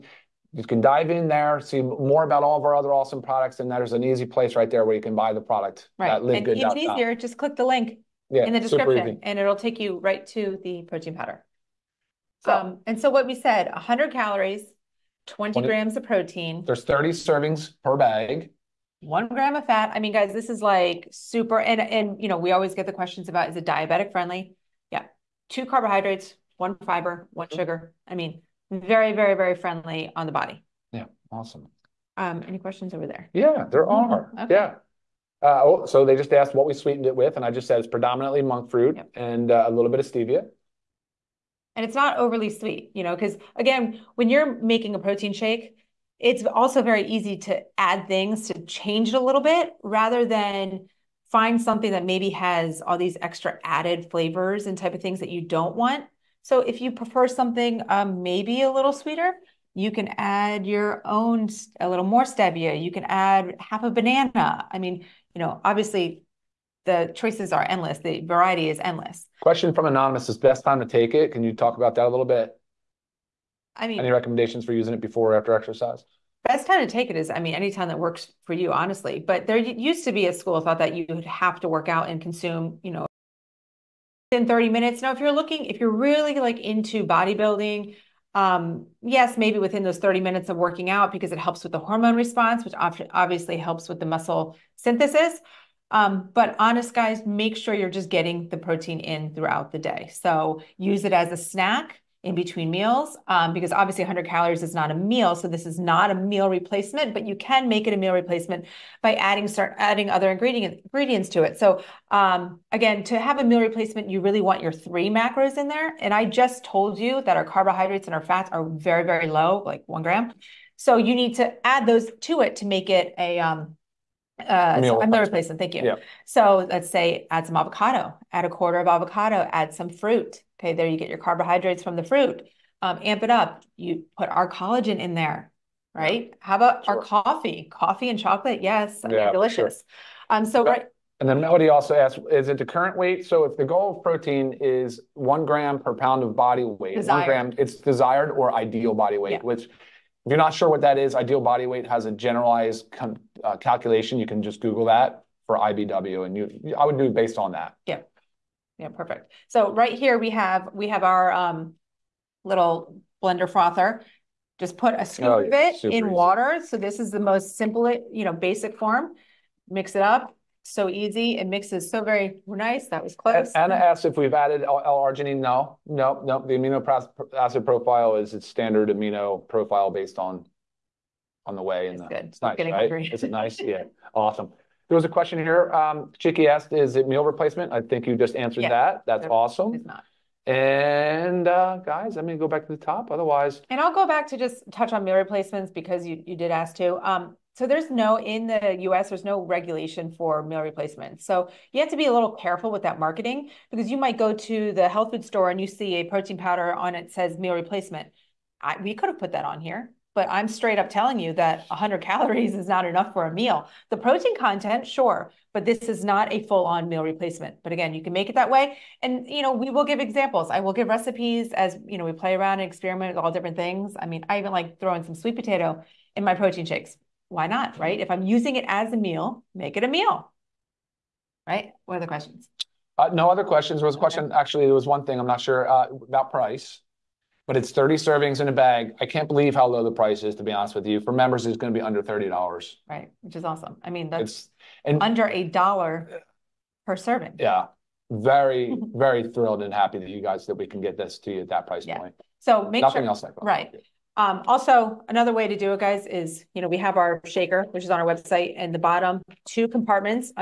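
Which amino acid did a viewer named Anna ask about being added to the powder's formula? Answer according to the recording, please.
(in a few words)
L-arginine.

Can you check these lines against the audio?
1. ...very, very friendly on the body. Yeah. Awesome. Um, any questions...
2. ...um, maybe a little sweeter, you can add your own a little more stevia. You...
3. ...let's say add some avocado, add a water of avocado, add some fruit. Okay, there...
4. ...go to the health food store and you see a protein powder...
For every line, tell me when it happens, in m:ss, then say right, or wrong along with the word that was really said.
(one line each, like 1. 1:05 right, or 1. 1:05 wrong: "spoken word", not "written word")
1. 0:29 right
2. 0:57 right
3. 2:06 wrong: "quarter", not "water"
4. 3:24 right.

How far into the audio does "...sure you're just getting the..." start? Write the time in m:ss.
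1:37.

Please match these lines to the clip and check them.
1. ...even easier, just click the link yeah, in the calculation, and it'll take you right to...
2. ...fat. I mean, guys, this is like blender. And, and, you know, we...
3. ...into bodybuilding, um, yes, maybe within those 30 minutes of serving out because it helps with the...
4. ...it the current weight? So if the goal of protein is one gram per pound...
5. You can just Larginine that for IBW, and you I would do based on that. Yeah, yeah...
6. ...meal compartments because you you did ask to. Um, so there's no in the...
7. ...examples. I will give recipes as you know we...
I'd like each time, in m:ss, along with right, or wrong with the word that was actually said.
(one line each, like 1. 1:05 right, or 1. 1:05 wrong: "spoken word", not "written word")
1. 0:06 wrong: "description", not "calculation"
2. 0:19 wrong: "super", not "blender"
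3. 1:26 wrong: "working", not "serving"
4. 2:22 right
5. 2:34 wrong: "Google", not "Larginine"
6. 3:15 wrong: "replacements", not "compartments"
7. 3:40 right.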